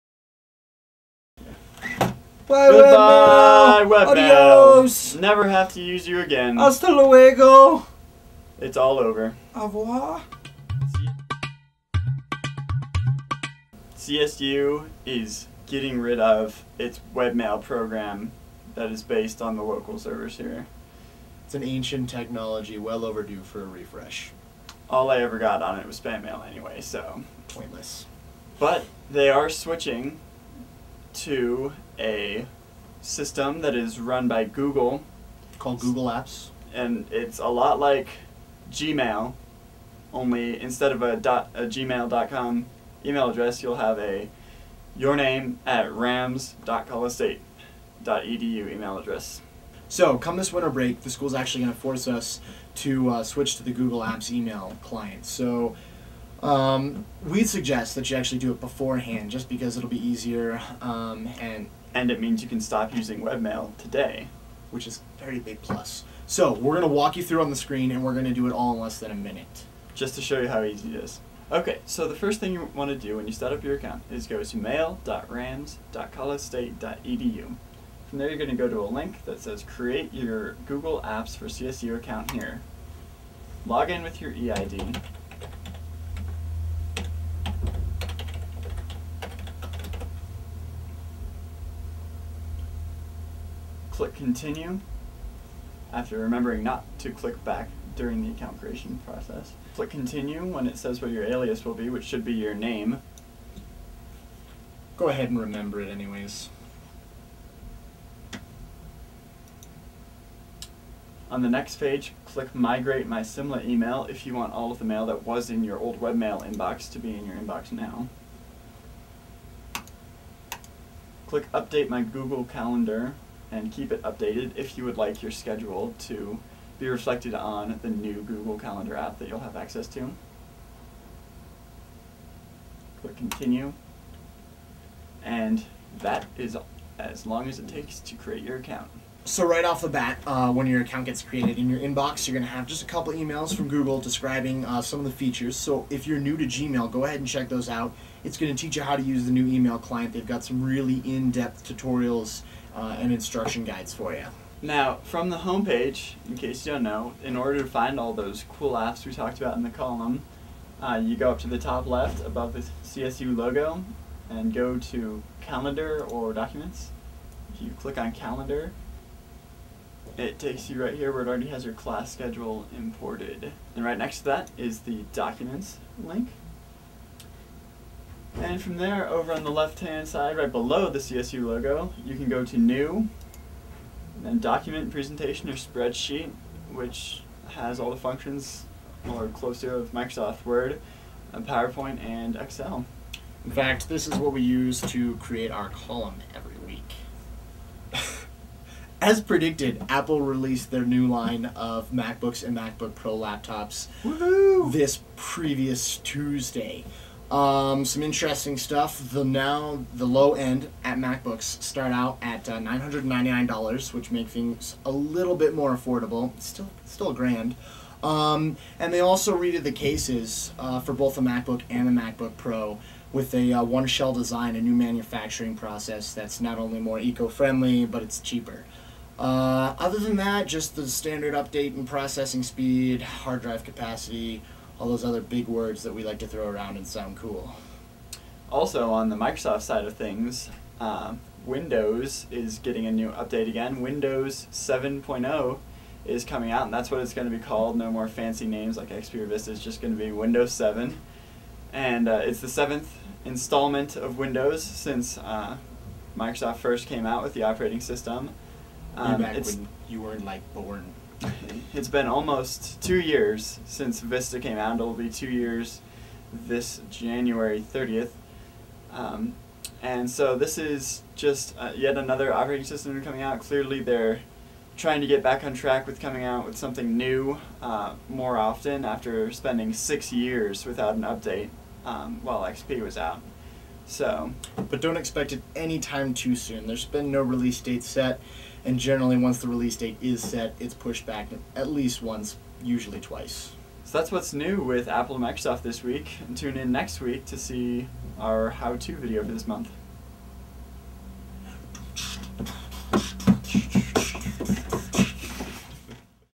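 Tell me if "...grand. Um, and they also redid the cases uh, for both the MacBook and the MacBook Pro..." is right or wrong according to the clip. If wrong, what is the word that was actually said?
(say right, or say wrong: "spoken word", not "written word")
right.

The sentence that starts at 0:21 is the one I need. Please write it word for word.
It's an ancient technology, well overdue for a refresh.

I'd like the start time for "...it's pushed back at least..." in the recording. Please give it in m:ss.
4:50.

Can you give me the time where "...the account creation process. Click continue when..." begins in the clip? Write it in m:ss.
1:38.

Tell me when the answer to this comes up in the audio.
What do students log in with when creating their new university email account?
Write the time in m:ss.
1:24.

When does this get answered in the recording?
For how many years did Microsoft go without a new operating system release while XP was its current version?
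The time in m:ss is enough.
4:39.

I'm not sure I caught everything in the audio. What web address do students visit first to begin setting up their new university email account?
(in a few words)
mail.rams.colostate.edu.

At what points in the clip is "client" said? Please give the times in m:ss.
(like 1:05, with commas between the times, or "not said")
0:54, 2:29.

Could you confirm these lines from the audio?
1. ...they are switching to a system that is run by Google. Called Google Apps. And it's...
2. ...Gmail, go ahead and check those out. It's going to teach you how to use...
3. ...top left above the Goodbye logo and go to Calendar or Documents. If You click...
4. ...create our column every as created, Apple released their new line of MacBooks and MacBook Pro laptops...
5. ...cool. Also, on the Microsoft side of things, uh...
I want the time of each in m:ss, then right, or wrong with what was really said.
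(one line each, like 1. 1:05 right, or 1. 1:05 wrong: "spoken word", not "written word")
1. 0:29 right
2. 2:26 right
3. 2:41 wrong: "CSU", not "Goodbye"
4. 3:15 wrong: "predicted", not "created"
5. 3:57 right.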